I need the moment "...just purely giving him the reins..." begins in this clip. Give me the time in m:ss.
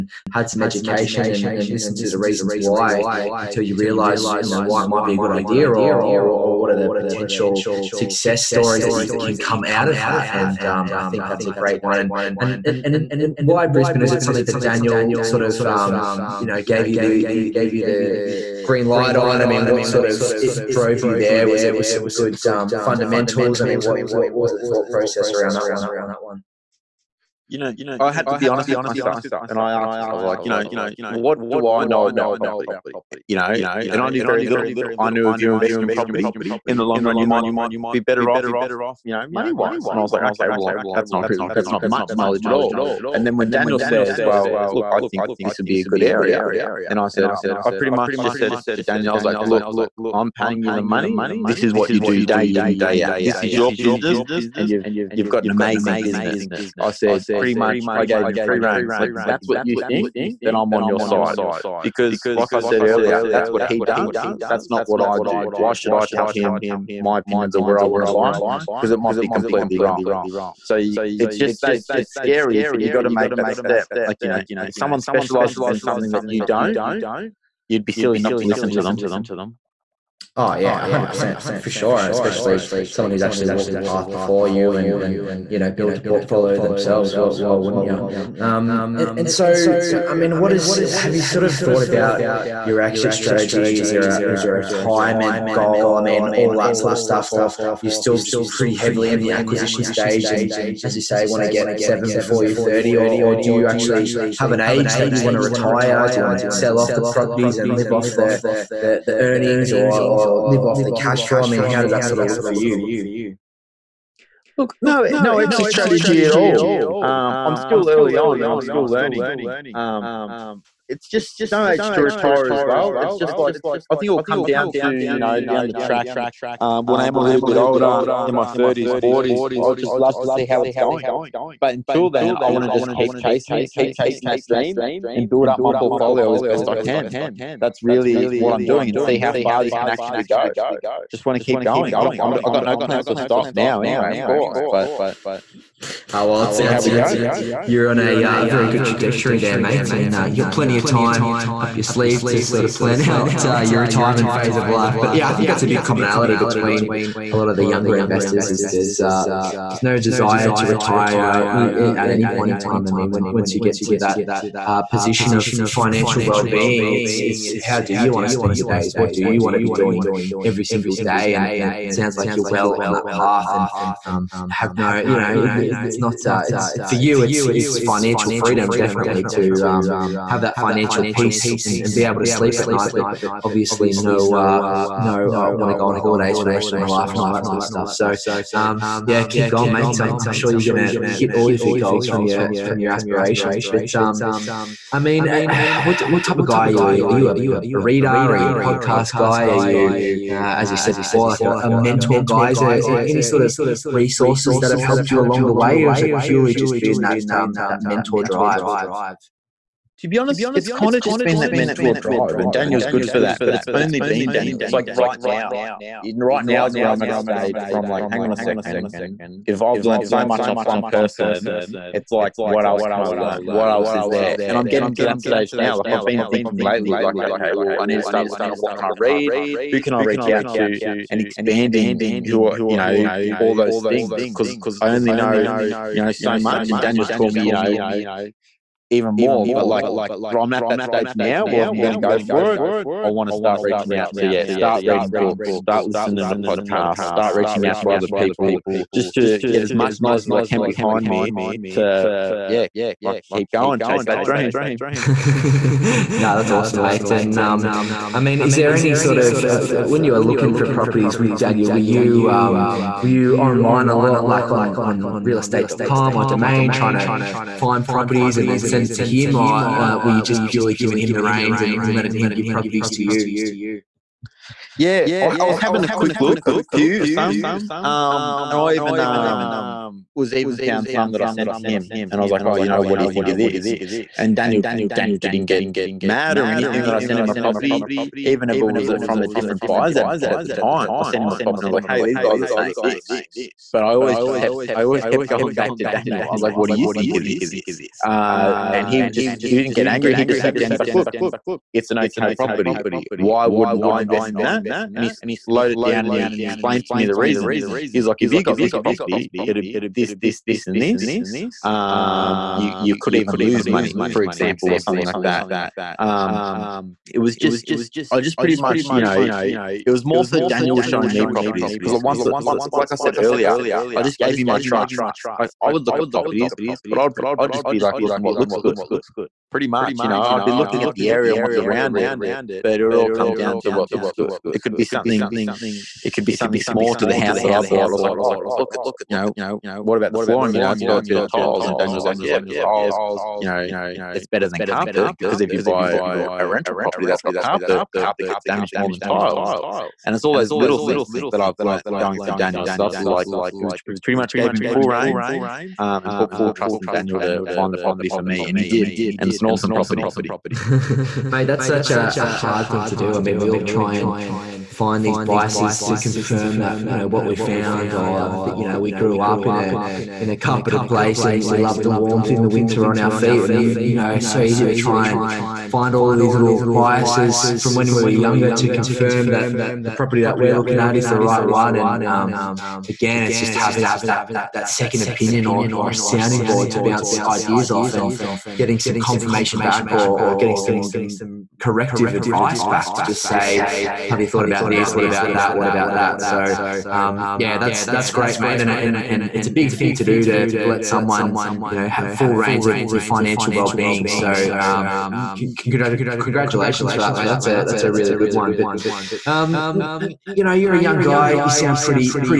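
4:30.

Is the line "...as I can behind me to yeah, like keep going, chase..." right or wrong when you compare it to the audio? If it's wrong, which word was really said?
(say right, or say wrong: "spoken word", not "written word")
right.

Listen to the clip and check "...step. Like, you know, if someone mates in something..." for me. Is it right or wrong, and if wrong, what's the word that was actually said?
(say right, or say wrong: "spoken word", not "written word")
wrong: "specializes", not "mates".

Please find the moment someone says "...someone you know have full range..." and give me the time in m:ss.
6:40.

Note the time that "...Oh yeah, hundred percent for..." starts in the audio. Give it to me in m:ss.
1:20.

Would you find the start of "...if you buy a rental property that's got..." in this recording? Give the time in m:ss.
5:45.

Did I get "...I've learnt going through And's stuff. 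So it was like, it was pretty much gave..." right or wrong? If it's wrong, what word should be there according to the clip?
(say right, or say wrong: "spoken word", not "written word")
wrong: "Daniel", not "And".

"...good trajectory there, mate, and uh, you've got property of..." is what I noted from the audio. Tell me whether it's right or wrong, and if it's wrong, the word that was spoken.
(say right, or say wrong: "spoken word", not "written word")
wrong: "plenty", not "property".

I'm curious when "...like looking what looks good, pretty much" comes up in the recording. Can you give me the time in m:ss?
5:27.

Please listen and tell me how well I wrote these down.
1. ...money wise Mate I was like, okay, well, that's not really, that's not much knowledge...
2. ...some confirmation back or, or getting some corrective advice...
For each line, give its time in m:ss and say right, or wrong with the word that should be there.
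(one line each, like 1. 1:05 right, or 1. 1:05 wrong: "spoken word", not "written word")
1. 0:39 wrong: "And", not "Mate"
2. 6:28 right.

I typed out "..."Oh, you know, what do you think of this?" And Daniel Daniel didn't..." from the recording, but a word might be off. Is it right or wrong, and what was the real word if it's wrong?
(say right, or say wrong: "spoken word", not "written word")
right.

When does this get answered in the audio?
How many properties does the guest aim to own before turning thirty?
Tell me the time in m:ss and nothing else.
1:41.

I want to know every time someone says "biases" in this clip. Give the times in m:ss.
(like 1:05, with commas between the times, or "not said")
6:05, 6:16.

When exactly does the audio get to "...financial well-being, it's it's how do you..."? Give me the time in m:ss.
2:45.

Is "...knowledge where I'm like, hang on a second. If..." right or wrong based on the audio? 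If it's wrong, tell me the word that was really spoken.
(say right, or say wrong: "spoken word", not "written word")
wrong: "stage", not "knowledge".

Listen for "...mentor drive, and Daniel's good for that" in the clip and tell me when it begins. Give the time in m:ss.
3:31.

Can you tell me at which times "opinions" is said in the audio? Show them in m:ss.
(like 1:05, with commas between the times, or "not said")
1:07, 6:25.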